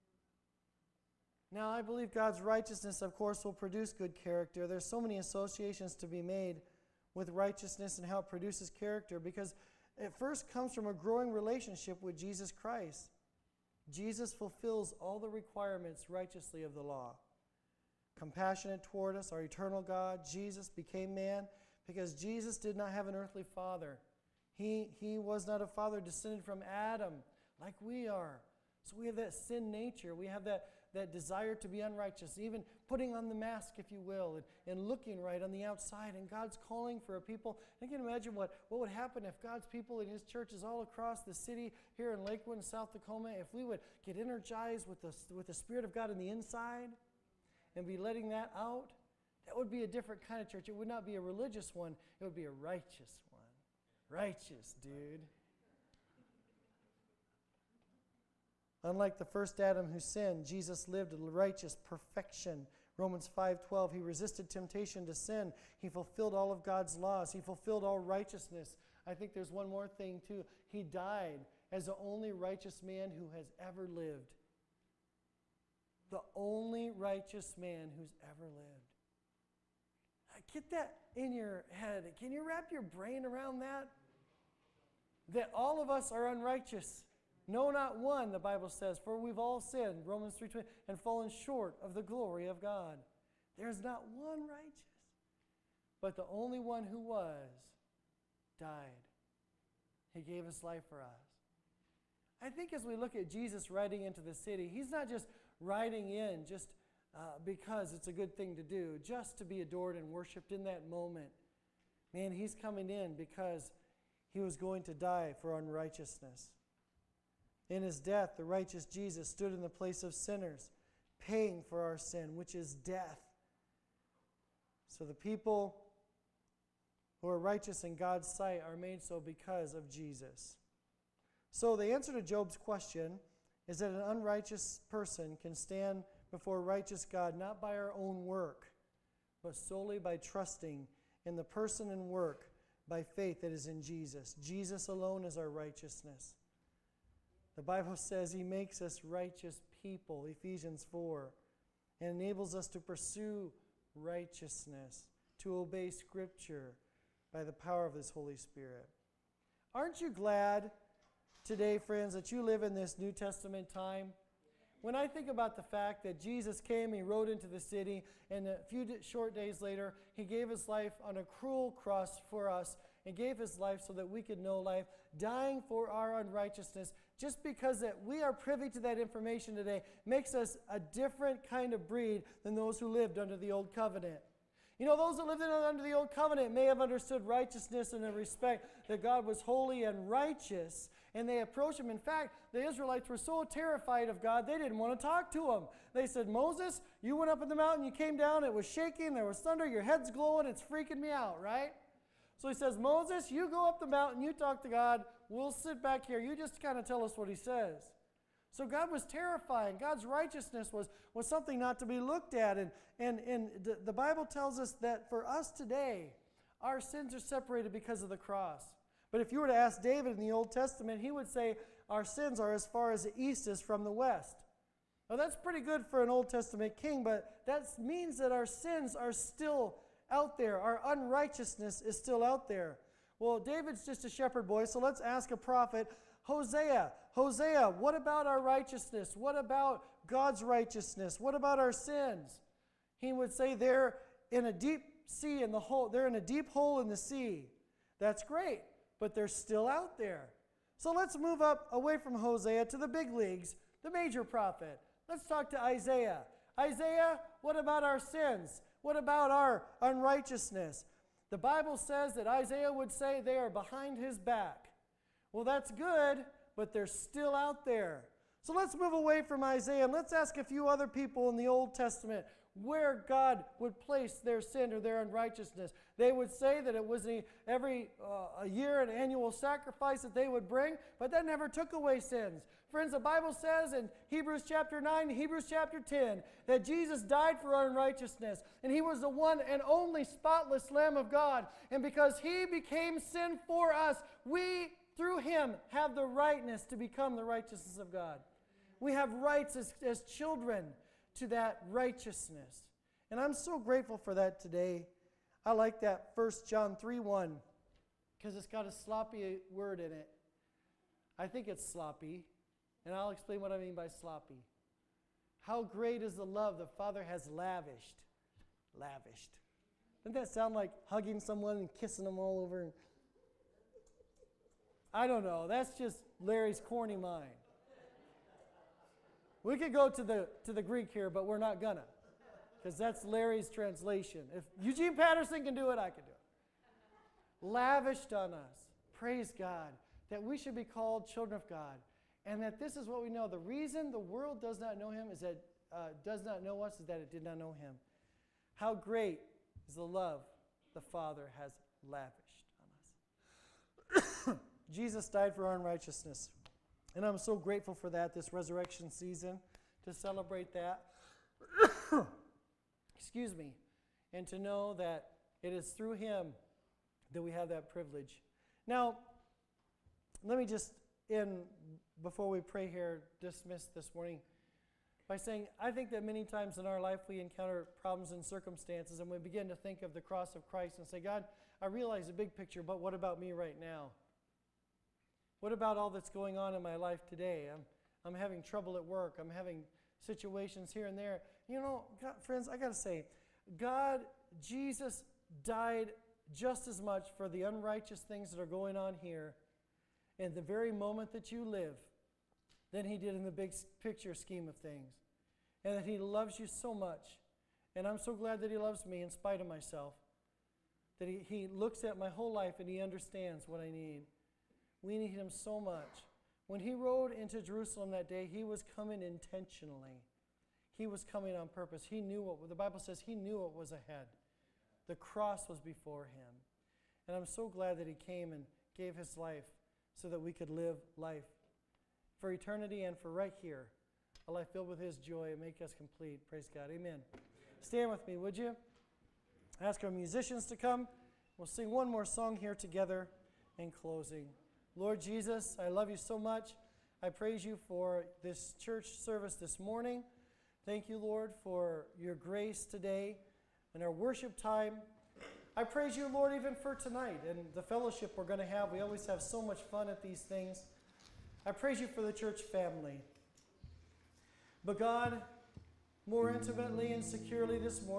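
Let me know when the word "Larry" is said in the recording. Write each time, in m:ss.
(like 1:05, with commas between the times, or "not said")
5:26, 5:33.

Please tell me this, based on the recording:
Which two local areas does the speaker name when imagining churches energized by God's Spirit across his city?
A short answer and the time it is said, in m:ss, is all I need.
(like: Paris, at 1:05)
Lakewood, South Tacoma, at 0:42.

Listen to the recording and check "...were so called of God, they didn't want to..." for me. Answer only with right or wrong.
wrong.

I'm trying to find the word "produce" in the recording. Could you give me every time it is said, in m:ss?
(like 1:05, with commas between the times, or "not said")
0:03, 0:08.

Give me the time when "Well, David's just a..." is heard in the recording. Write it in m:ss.
3:53.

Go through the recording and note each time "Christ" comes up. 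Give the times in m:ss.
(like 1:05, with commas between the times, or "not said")
0:12, 6:20.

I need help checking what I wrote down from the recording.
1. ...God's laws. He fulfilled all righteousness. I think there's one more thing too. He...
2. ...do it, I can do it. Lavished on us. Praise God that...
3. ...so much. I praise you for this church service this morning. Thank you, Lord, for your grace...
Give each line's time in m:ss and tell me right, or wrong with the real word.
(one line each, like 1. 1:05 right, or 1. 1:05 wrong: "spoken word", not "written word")
1. 1:06 right
2. 5:35 right
3. 7:25 right.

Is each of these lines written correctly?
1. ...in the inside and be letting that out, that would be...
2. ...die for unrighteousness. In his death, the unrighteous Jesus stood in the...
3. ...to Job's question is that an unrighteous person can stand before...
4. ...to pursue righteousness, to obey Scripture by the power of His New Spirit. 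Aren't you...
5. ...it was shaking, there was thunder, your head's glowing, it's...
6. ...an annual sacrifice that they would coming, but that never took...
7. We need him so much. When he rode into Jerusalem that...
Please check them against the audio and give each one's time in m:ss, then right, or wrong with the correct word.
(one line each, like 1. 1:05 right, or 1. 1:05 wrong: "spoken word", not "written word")
1. 0:46 right
2. 1:54 wrong: "righteous", not "unrighteous"
3. 2:12 right
4. 2:32 wrong: "Holy", not "New"
5. 3:18 right
6. 4:38 wrong: "bring", not "coming"
7. 6:54 right.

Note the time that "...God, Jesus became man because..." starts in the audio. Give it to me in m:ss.
0:19.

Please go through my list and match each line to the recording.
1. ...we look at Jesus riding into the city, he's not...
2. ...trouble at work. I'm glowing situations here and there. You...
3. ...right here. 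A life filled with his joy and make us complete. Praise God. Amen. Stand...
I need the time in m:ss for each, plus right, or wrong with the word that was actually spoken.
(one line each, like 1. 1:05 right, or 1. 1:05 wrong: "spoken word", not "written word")
1. 1:42 right
2. 6:28 wrong: "having", not "glowing"
3. 7:13 right.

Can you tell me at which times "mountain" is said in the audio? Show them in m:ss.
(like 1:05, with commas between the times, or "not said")
3:17, 3:23.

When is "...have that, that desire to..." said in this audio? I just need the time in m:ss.
0:30.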